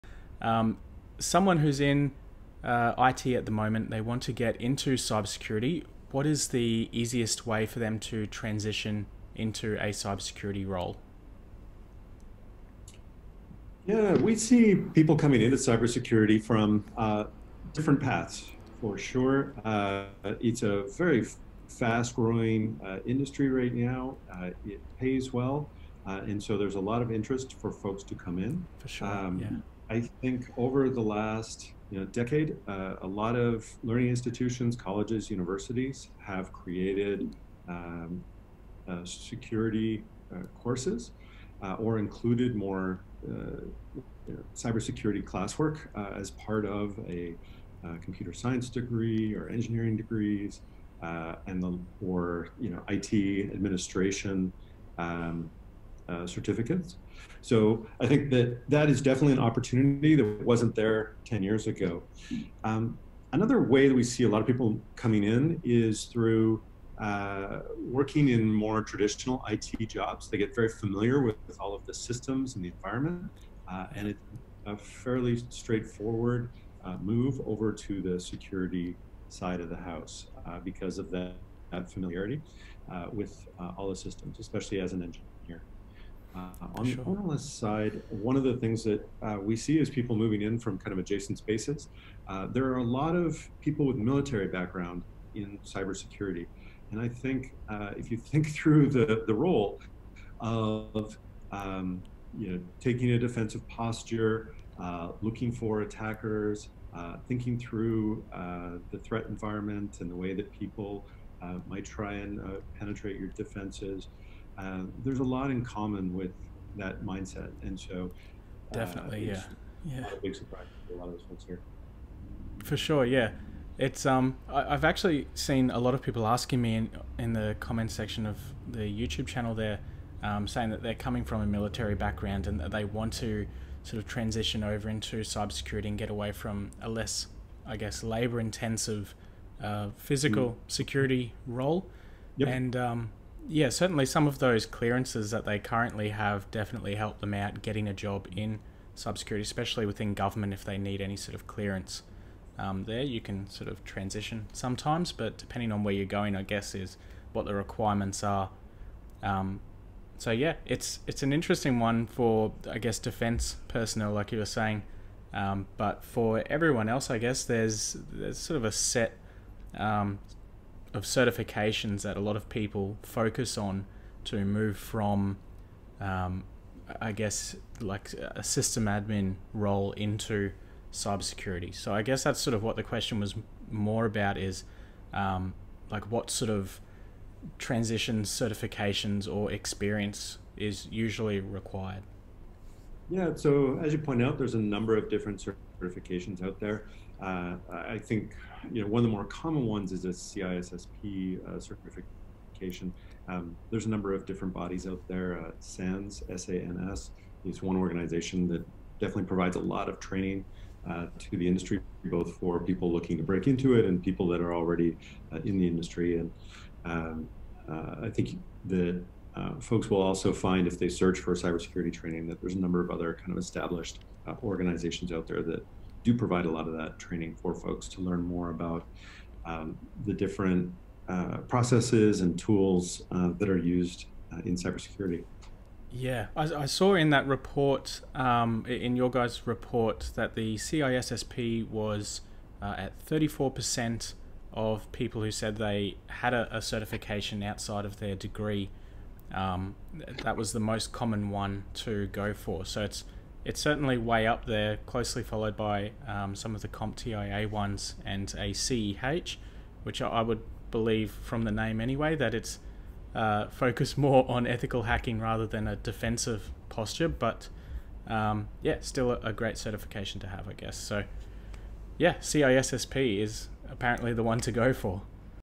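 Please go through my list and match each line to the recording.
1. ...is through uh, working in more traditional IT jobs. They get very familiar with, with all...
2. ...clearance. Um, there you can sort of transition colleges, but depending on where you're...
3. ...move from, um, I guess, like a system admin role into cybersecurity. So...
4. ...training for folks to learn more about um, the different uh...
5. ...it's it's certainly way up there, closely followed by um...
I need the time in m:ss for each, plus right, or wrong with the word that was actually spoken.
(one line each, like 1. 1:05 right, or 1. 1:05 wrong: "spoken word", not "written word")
1. 1:05 right
2. 2:31 wrong: "sometimes", not "colleges"
3. 2:54 right
4. 3:46 right
5. 4:12 right.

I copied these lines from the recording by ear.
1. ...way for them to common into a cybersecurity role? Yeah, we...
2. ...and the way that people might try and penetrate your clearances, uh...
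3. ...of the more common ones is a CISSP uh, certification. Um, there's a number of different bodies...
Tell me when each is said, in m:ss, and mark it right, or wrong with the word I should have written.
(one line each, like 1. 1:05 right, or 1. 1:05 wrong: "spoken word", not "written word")
1. 0:07 wrong: "transition", not "common"
2. 1:50 wrong: "defenses", not "clearances"
3. 3:19 right.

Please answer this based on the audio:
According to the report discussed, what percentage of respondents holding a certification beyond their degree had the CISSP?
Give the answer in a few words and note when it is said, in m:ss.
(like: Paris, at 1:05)
34%, at 4:03.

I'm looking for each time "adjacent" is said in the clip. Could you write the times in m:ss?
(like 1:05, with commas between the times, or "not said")
1:30.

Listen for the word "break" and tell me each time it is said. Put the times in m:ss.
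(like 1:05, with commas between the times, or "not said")
3:33.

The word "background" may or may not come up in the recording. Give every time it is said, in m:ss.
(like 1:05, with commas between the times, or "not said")
1:34, 2:11.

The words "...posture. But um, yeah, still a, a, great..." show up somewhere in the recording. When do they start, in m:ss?
4:26.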